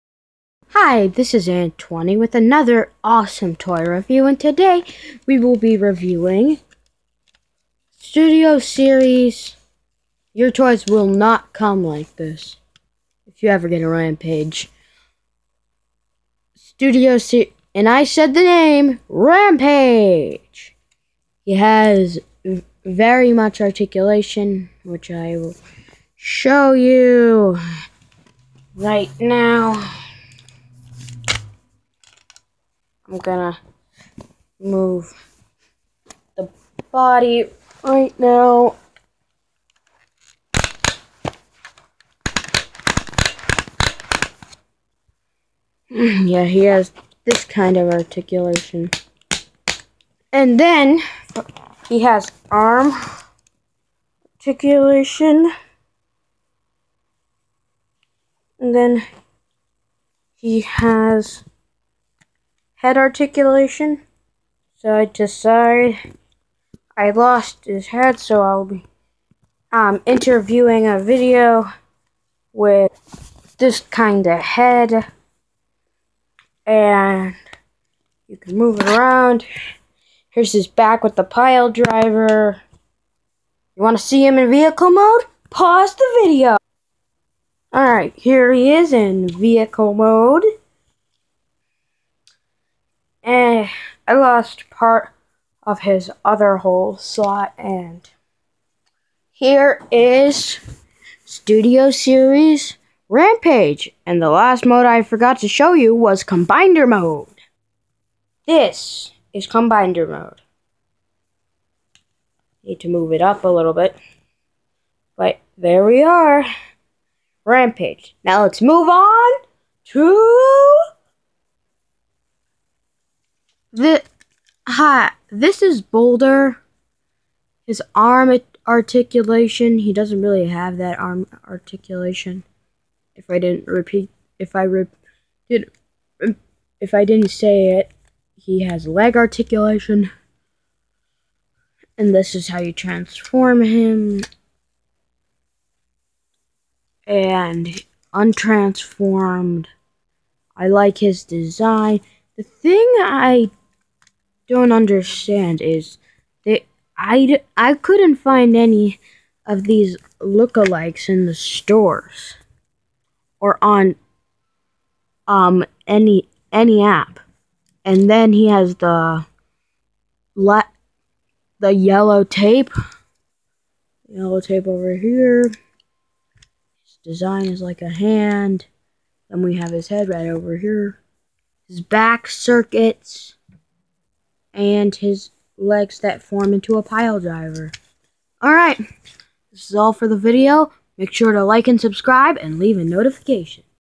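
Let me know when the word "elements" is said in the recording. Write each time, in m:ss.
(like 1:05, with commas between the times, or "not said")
not said.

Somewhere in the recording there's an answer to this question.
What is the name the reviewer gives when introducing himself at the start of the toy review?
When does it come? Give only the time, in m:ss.
0:01.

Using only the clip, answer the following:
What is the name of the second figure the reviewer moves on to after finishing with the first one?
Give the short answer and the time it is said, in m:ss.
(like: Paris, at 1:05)
Boulder, at 2:05.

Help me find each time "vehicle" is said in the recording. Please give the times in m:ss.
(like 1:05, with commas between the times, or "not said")
1:24, 1:29.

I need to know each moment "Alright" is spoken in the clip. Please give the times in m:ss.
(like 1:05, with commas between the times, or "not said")
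1:27, 3:08.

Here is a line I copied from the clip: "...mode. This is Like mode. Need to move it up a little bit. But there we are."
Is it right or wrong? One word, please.
wrong.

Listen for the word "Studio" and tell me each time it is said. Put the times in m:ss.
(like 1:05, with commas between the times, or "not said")
0:07, 0:16, 1:41.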